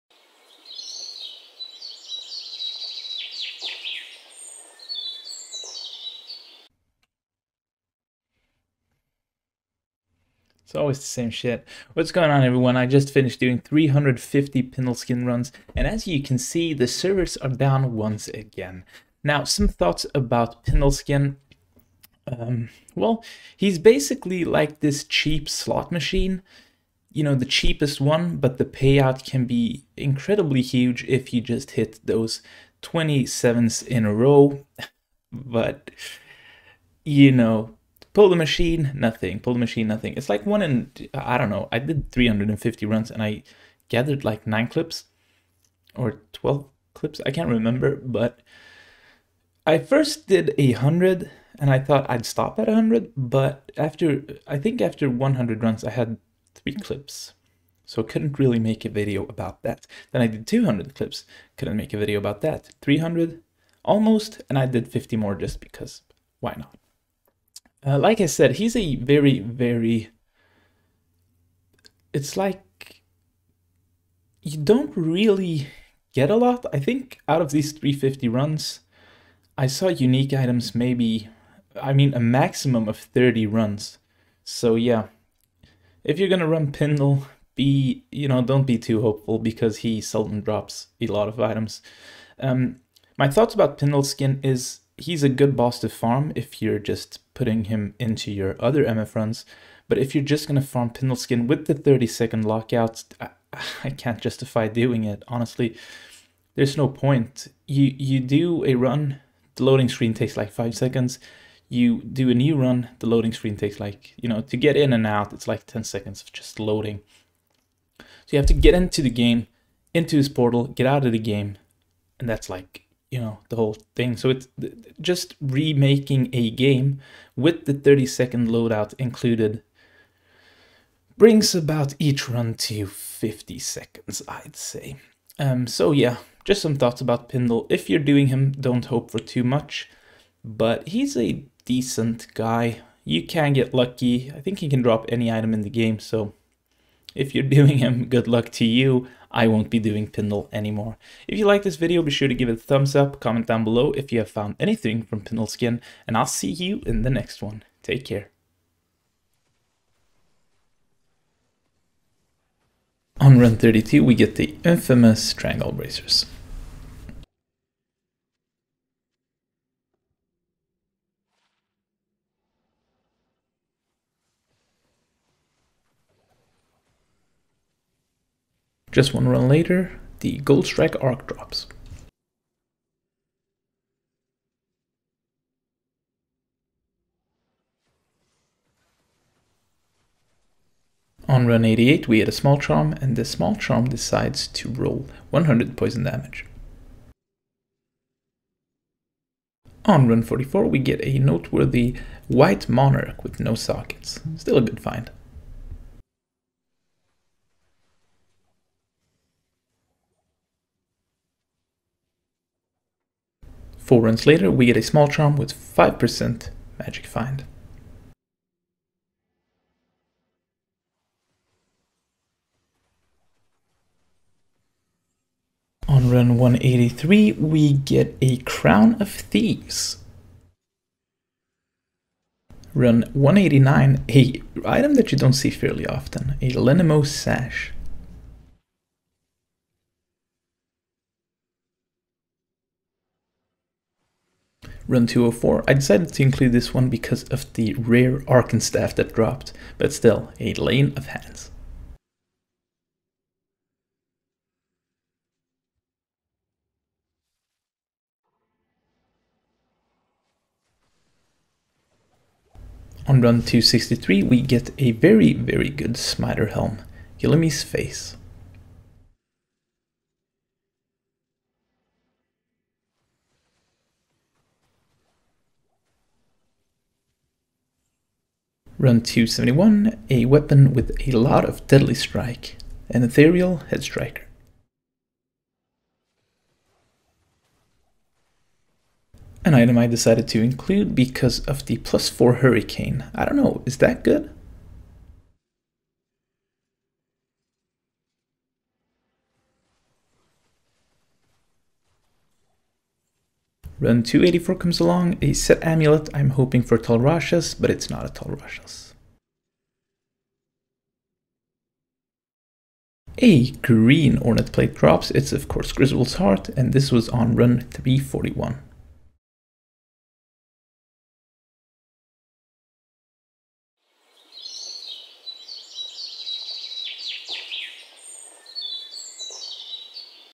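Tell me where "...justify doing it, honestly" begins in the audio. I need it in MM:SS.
01:44.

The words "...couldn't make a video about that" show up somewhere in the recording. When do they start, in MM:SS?
01:01.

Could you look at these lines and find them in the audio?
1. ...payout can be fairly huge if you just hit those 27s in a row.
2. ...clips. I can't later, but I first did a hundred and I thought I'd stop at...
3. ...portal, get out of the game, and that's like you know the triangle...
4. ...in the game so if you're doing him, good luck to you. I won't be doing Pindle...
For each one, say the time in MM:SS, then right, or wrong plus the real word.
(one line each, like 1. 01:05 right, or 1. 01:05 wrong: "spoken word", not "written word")
1. 00:28 wrong: "incredibly", not "fairly"
2. 00:46 wrong: "remember", not "later"
3. 02:00 wrong: "whole", not "triangle"
4. 02:25 right.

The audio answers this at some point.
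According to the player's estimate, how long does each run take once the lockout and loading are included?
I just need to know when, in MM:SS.
02:12.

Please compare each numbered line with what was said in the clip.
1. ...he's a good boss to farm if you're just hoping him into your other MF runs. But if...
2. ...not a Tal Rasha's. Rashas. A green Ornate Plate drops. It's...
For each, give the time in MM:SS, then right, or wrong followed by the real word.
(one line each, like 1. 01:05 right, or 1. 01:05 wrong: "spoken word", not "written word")
1. 01:34 wrong: "putting", not "hoping"
2. 05:07 right.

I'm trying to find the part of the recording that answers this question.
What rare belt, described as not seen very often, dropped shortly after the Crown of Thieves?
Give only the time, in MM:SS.
03:56.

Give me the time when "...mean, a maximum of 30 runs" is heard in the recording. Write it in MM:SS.
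01:21.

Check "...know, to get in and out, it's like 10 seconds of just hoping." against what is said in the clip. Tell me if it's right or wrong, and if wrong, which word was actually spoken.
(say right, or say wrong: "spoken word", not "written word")
wrong: "loading", not "hoping".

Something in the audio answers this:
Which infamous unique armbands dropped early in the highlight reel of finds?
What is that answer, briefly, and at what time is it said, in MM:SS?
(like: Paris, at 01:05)
triangle bracers, at 02:45.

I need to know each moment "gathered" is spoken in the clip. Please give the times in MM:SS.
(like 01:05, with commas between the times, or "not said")
00:43.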